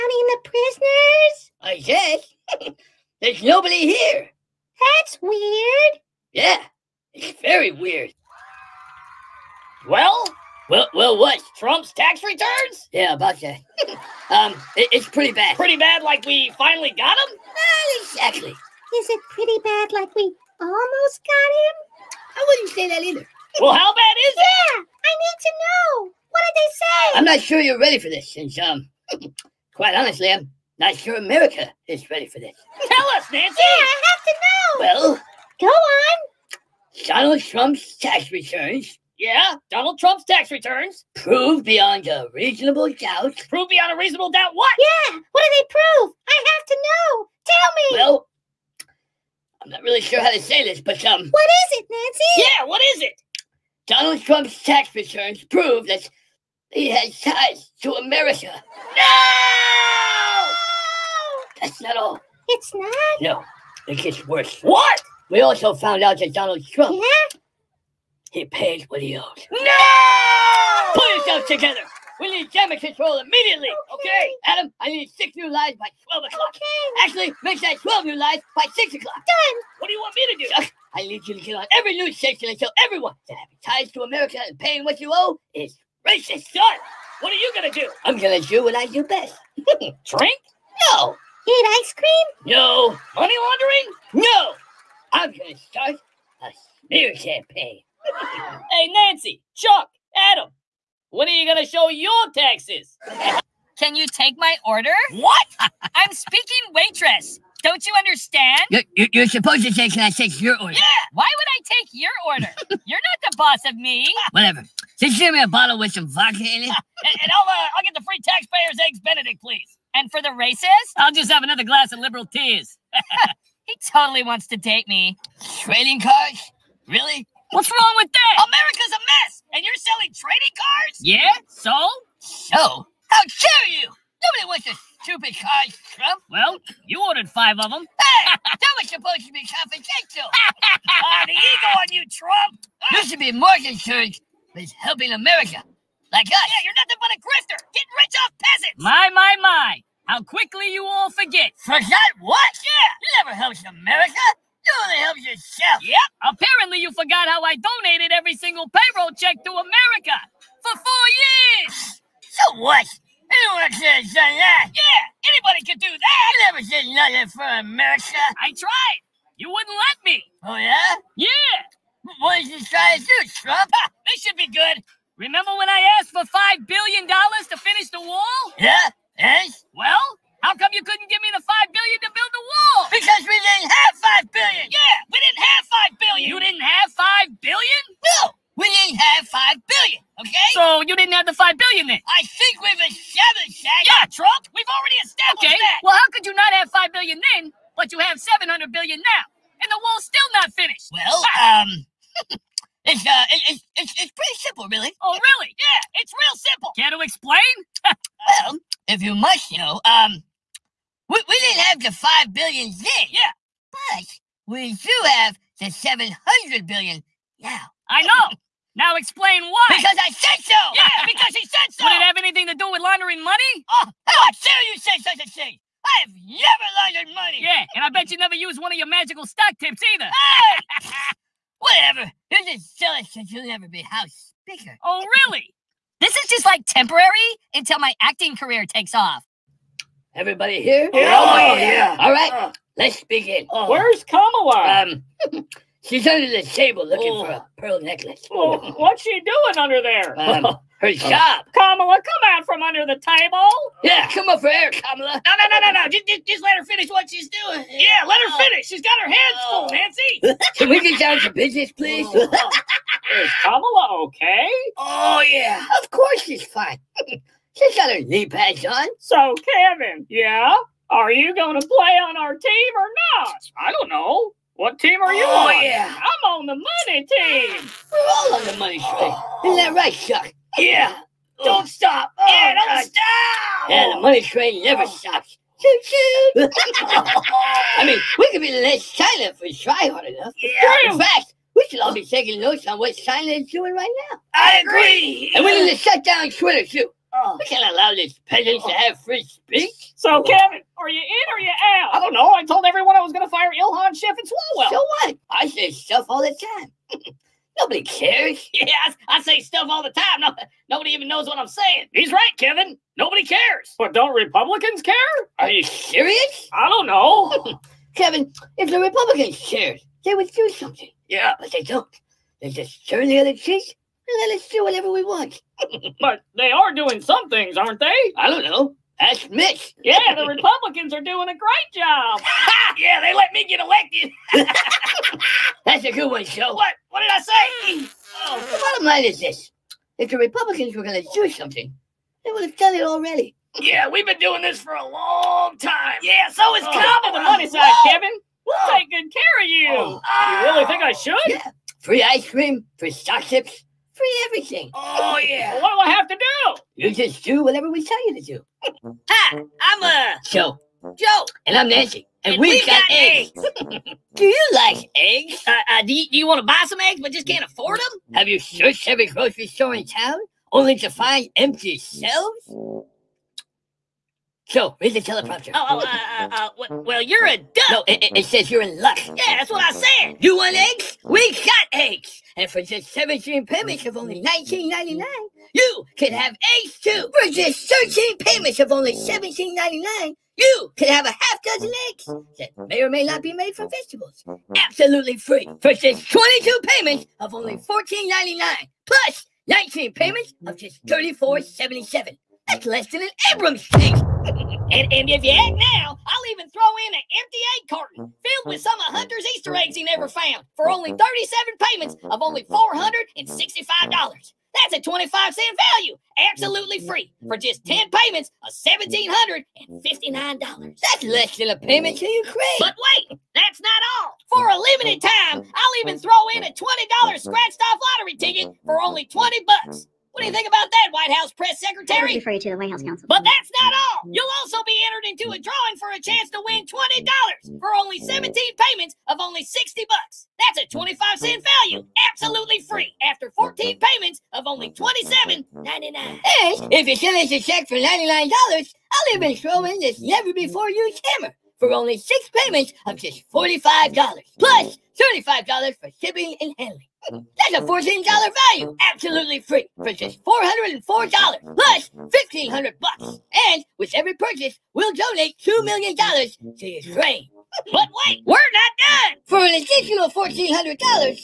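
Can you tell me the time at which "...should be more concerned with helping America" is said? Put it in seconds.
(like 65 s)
143 s.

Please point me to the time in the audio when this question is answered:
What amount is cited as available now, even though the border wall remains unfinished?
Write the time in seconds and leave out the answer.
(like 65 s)
198 s.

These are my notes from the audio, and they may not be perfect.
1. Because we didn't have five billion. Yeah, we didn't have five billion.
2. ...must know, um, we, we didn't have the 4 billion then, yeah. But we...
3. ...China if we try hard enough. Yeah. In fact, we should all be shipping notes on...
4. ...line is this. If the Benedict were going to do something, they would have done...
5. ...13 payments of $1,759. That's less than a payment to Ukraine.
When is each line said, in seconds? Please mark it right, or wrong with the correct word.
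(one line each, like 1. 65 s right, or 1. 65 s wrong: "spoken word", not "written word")
1. 182 s right
2. 209 s wrong: "5", not "4"
3. 289 s wrong: "taking", not "shipping"
4. 338 s wrong: "Republicans", not "Benedict"
5. 417 s wrong: "10", not "13".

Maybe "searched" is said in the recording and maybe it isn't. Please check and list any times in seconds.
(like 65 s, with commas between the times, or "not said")
368 s.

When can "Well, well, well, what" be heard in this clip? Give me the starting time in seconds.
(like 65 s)
9 s.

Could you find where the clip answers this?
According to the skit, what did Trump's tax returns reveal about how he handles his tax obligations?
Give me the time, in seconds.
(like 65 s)
68 s.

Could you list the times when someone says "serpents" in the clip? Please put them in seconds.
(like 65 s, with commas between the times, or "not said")
not said.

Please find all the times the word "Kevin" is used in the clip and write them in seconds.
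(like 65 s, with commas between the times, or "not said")
269 s, 300 s, 312 s, 317 s, 347 s.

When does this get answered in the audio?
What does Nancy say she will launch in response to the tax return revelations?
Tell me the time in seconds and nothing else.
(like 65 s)
96 s.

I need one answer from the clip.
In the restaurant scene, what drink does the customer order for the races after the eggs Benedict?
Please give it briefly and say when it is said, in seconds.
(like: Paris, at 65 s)
Liberal tears, at 121 s.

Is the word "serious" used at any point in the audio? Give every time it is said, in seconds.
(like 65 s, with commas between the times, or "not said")
315 s.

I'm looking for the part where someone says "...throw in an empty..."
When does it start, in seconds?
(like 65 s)
406 s.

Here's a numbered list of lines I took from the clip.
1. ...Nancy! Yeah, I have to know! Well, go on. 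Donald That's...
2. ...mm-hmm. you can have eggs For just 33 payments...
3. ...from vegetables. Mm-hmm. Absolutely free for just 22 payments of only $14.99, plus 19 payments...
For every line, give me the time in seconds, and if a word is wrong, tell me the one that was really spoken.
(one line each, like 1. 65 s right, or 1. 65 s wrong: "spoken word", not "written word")
1. 33 s wrong: "Trump", not "That"
2. 384 s wrong: "13", not "33"
3. 393 s right.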